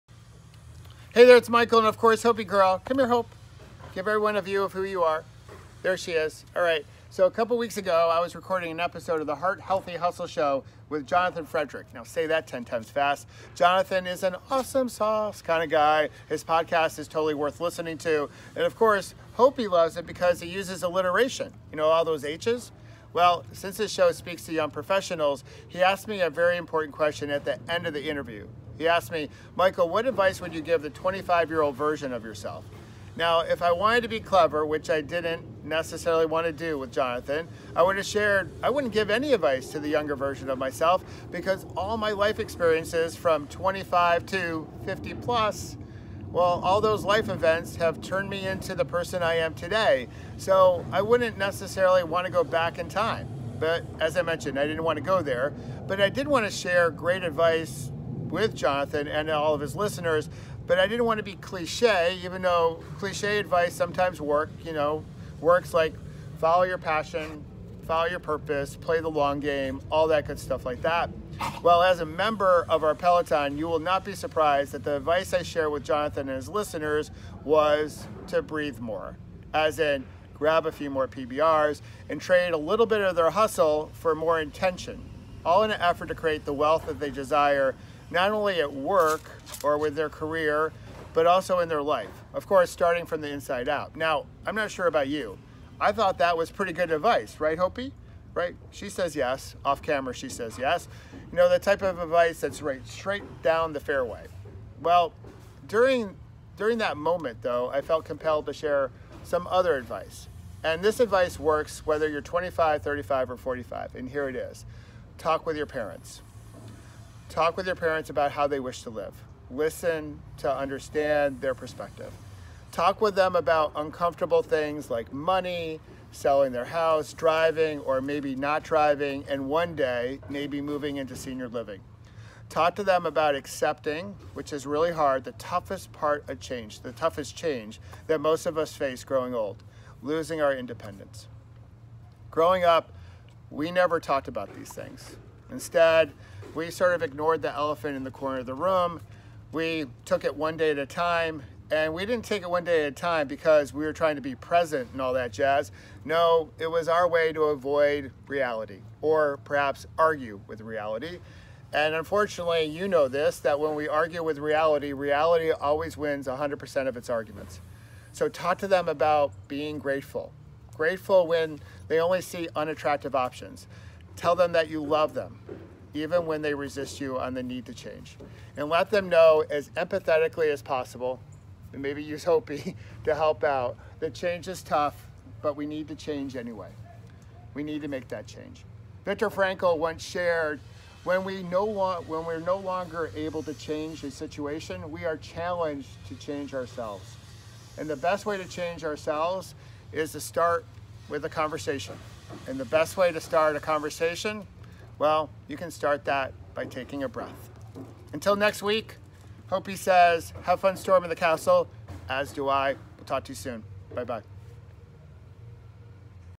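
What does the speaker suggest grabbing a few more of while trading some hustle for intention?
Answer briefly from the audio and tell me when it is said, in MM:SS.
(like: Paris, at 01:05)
PBRs, at 01:21.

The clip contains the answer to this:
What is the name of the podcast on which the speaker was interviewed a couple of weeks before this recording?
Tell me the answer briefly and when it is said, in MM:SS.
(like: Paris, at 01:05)
Heart Healthy Hustle Show, at 00:09.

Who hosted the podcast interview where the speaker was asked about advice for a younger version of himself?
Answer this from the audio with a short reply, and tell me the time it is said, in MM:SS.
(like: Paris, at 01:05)
Jonathan Frederick, at 00:11.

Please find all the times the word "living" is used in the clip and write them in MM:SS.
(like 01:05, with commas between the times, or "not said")
02:11.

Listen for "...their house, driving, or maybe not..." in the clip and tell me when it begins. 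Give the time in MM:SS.
02:06.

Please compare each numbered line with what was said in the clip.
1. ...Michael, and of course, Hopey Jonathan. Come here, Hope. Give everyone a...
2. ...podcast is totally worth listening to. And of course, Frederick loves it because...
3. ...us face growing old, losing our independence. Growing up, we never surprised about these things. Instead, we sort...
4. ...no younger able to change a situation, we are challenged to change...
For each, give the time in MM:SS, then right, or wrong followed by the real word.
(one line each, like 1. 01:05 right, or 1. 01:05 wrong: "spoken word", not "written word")
1. 00:01 wrong: "Girl", not "Jonathan"
2. 00:16 wrong: "Hopey", not "Frederick"
3. 02:18 wrong: "talked", not "surprised"
4. 03:12 wrong: "longer", not "younger".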